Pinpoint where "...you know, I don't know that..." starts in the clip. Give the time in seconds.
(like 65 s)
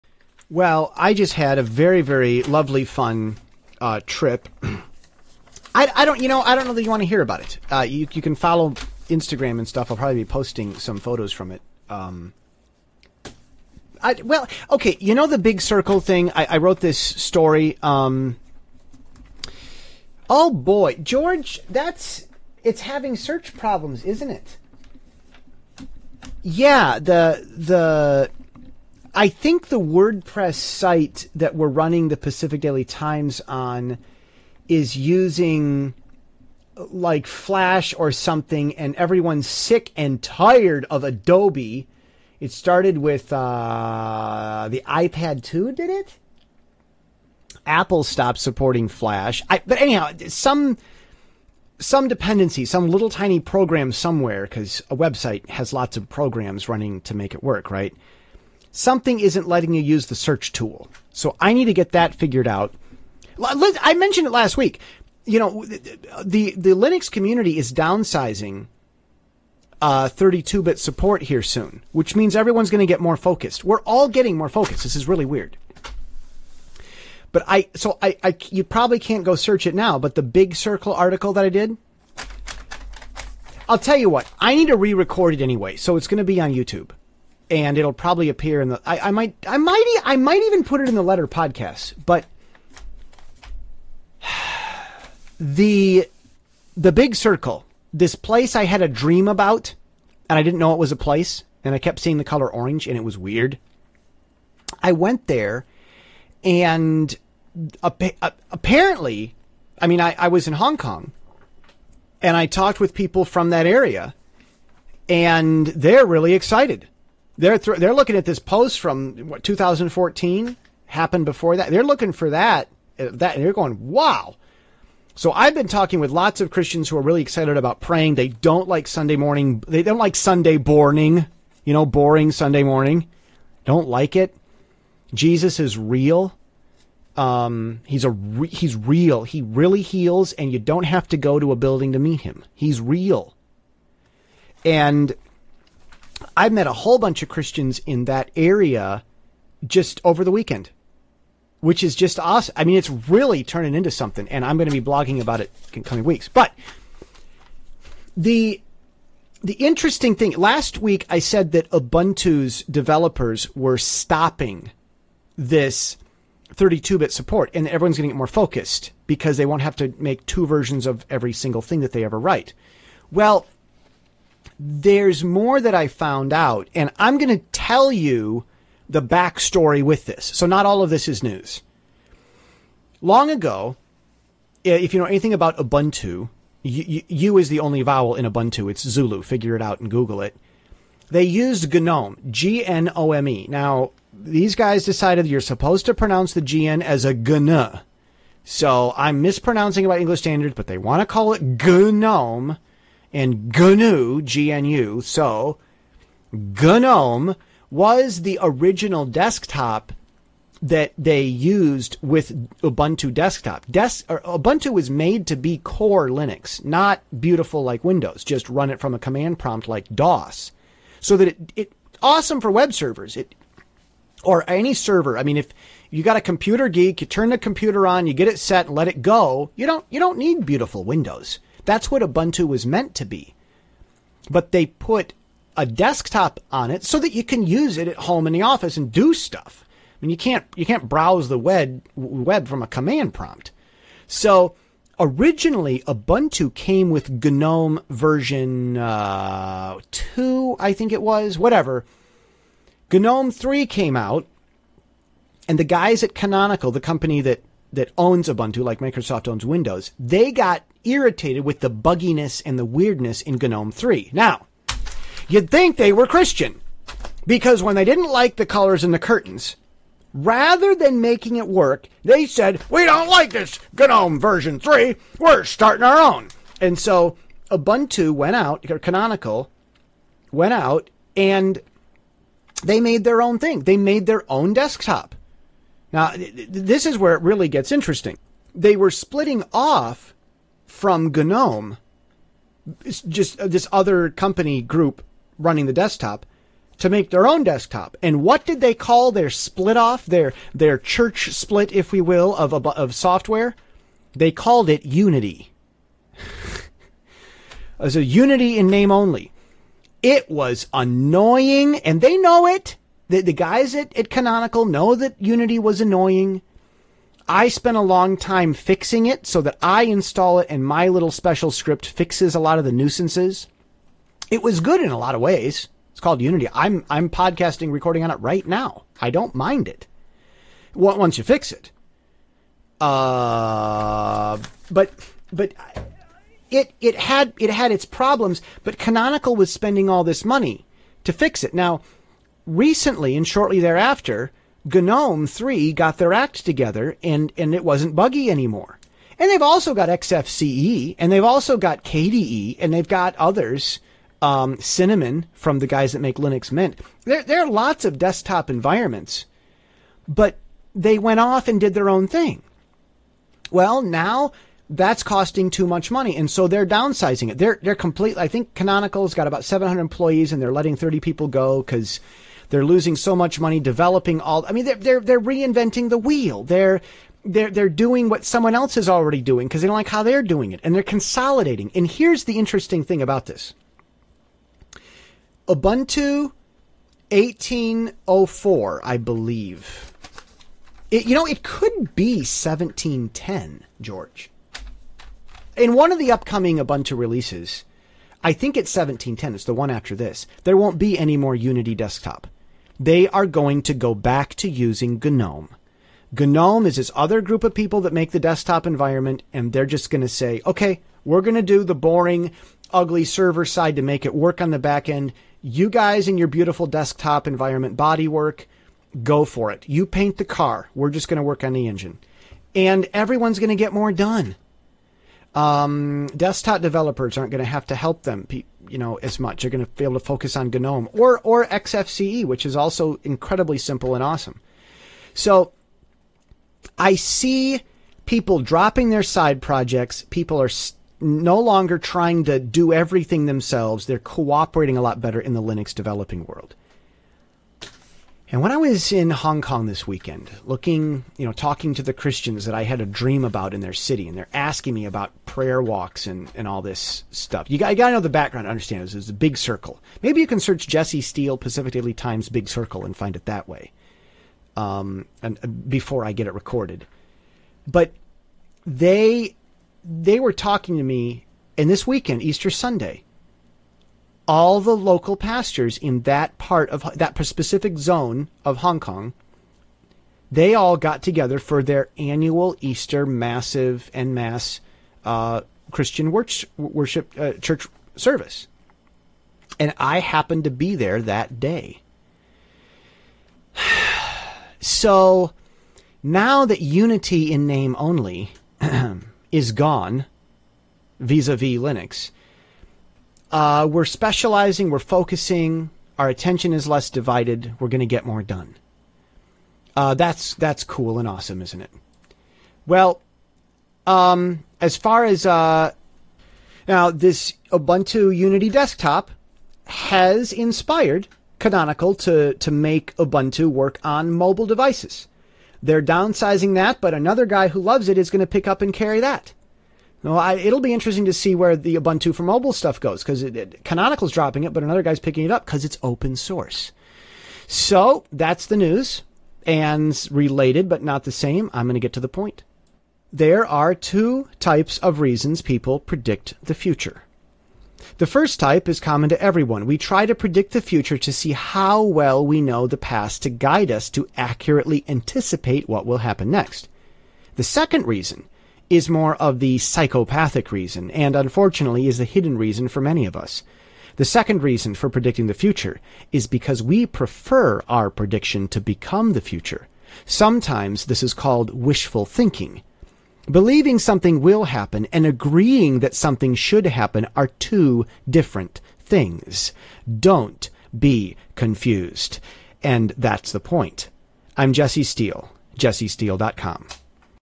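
6 s.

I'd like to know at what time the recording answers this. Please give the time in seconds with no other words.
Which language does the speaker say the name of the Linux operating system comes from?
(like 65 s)
188 s.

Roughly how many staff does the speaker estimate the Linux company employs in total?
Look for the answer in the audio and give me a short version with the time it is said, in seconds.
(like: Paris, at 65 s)
700, at 369 s.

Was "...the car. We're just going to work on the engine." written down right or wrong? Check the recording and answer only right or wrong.
right.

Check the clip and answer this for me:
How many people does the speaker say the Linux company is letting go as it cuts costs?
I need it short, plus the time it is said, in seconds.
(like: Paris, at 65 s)
30, at 370 s.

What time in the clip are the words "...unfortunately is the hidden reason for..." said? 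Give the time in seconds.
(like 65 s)
561 s.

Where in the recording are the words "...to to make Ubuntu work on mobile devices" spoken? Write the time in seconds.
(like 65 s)
521 s.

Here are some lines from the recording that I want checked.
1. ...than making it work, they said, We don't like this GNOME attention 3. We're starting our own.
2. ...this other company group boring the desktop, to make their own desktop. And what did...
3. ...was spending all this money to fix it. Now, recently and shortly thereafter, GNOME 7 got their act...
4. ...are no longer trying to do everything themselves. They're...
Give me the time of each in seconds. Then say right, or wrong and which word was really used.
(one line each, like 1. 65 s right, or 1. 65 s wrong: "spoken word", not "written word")
1. 270 s wrong: "version", not "attention"
2. 293 s wrong: "running", not "boring"
3. 339 s wrong: "3", not "7"
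4. 440 s right.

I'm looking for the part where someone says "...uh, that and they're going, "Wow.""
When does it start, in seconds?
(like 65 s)
122 s.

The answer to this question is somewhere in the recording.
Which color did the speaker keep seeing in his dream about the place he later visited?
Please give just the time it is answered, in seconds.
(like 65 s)
102 s.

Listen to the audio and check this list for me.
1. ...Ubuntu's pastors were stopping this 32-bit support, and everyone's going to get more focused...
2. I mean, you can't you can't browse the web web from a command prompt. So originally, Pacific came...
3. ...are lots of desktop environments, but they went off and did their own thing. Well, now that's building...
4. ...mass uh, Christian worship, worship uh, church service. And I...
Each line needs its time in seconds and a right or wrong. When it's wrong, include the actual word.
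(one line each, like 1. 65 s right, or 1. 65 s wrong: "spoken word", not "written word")
1. 161 s wrong: "developers", not "pastors"
2. 239 s wrong: "Ubuntu", not "Pacific"
3. 357 s wrong: "costing", not "building"
4. 484 s right.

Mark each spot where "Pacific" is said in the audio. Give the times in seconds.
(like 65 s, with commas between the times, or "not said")
32 s, 461 s.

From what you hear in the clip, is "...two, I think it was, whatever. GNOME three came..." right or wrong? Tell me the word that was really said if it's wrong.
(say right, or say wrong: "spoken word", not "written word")
right.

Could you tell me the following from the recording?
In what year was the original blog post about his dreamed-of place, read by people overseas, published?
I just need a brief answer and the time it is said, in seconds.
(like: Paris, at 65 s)
2014, at 119 s.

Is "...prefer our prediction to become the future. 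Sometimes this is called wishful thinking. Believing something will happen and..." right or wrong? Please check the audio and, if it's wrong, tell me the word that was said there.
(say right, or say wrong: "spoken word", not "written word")
right.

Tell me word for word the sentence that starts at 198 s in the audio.
So I'm mispronouncing about English standards, but they want to call it GNOME and GNU, GNU.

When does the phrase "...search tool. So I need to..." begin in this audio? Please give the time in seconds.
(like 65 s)
60 s.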